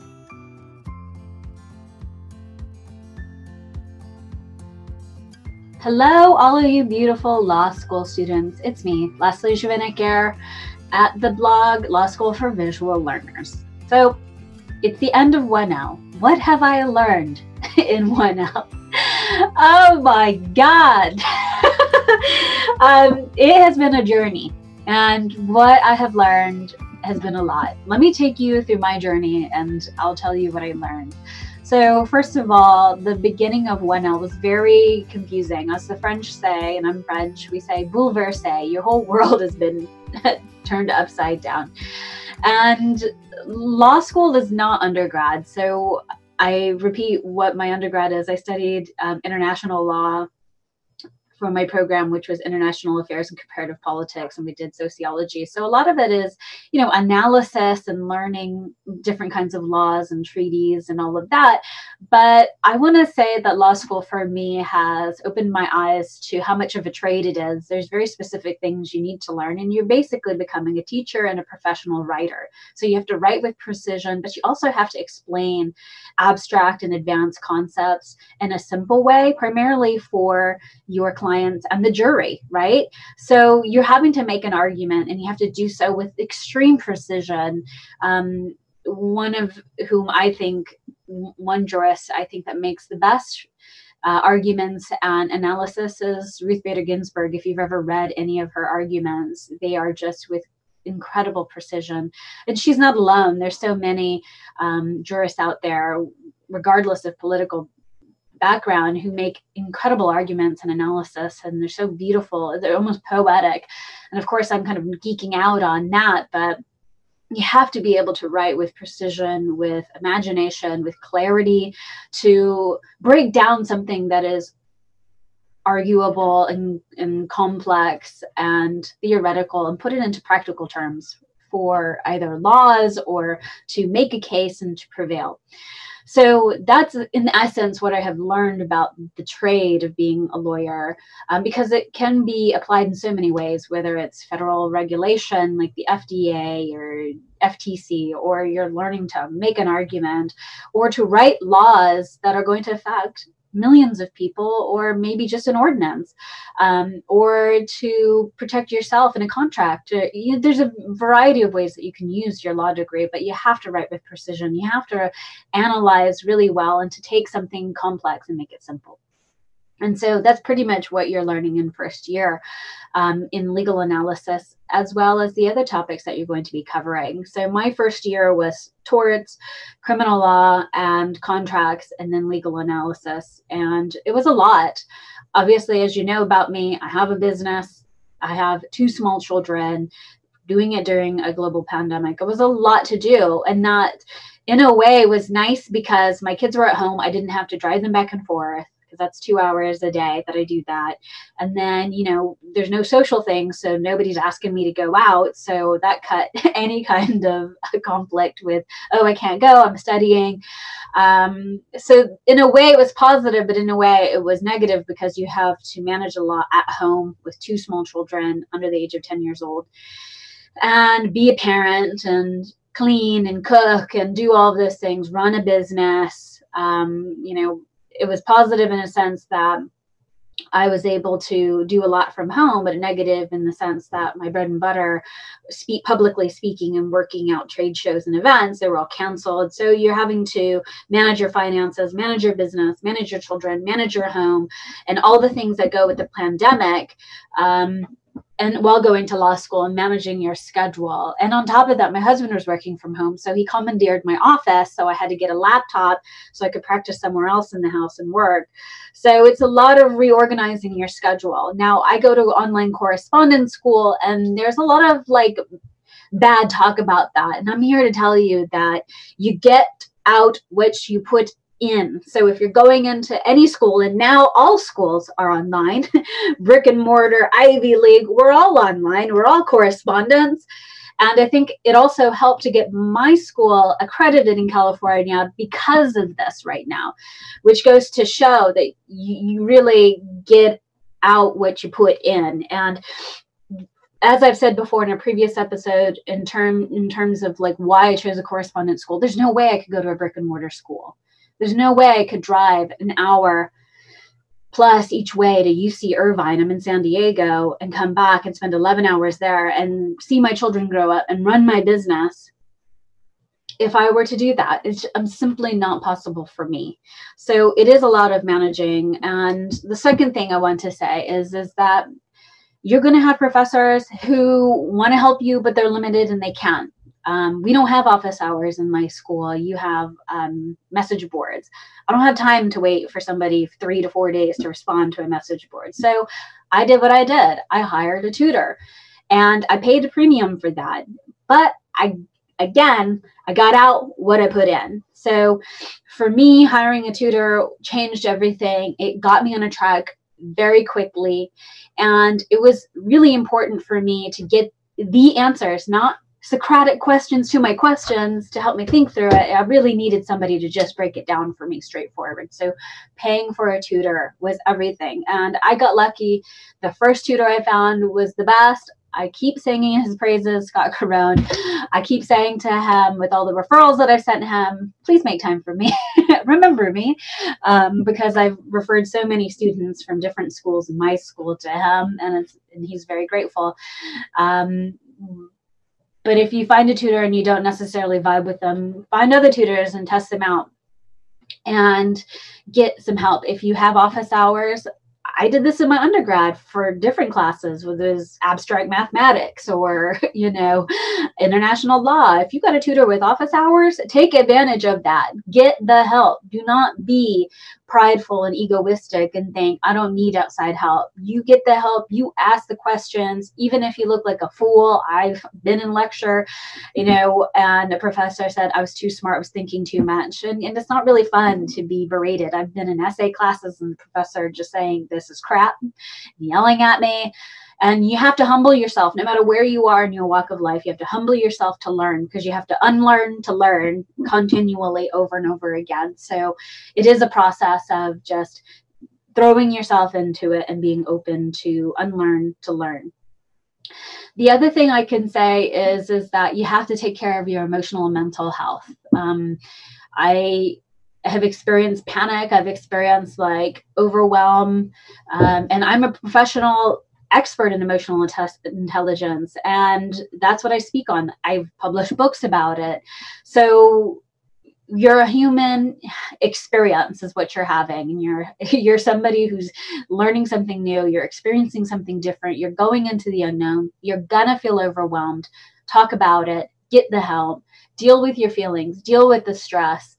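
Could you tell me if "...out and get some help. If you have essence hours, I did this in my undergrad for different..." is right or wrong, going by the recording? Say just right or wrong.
wrong.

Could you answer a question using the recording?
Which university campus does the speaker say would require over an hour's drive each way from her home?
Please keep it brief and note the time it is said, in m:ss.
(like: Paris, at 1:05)
UC Irvine, at 5:05.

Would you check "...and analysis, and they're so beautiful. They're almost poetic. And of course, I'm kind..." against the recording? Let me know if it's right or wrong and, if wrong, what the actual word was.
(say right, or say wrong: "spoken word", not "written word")
right.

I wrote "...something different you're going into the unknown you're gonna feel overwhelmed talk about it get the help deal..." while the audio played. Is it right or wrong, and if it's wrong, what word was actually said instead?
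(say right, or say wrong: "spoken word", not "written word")
right.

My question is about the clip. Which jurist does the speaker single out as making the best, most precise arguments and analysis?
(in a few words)
Ruth Bader Ginsburg.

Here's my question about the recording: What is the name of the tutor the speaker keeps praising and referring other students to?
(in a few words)
Scott Carone.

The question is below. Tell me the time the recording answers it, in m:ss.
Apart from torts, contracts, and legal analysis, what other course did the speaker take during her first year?
2:59.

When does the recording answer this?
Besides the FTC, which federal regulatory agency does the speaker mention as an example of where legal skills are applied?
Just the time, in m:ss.
2:25.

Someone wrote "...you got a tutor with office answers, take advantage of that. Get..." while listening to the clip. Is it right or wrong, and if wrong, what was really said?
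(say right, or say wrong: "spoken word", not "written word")
wrong: "hours", not "answers".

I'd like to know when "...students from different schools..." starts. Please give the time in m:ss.
6:19.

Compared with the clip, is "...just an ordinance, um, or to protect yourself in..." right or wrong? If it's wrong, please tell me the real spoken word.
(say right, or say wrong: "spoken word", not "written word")
right.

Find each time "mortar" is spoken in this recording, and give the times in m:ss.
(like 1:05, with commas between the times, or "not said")
4:36, 5:00.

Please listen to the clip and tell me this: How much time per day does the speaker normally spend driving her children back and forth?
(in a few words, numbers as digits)
2 hours.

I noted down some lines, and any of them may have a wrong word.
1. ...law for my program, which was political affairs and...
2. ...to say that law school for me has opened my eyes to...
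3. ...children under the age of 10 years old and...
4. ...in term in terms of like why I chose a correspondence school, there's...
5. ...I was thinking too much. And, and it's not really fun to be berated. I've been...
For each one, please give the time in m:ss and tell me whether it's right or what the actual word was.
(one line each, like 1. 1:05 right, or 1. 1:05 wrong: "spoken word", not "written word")
1. 0:49 wrong: "international", not "political"
2. 1:02 right
3. 3:37 right
4. 4:56 right
5. 6:59 right.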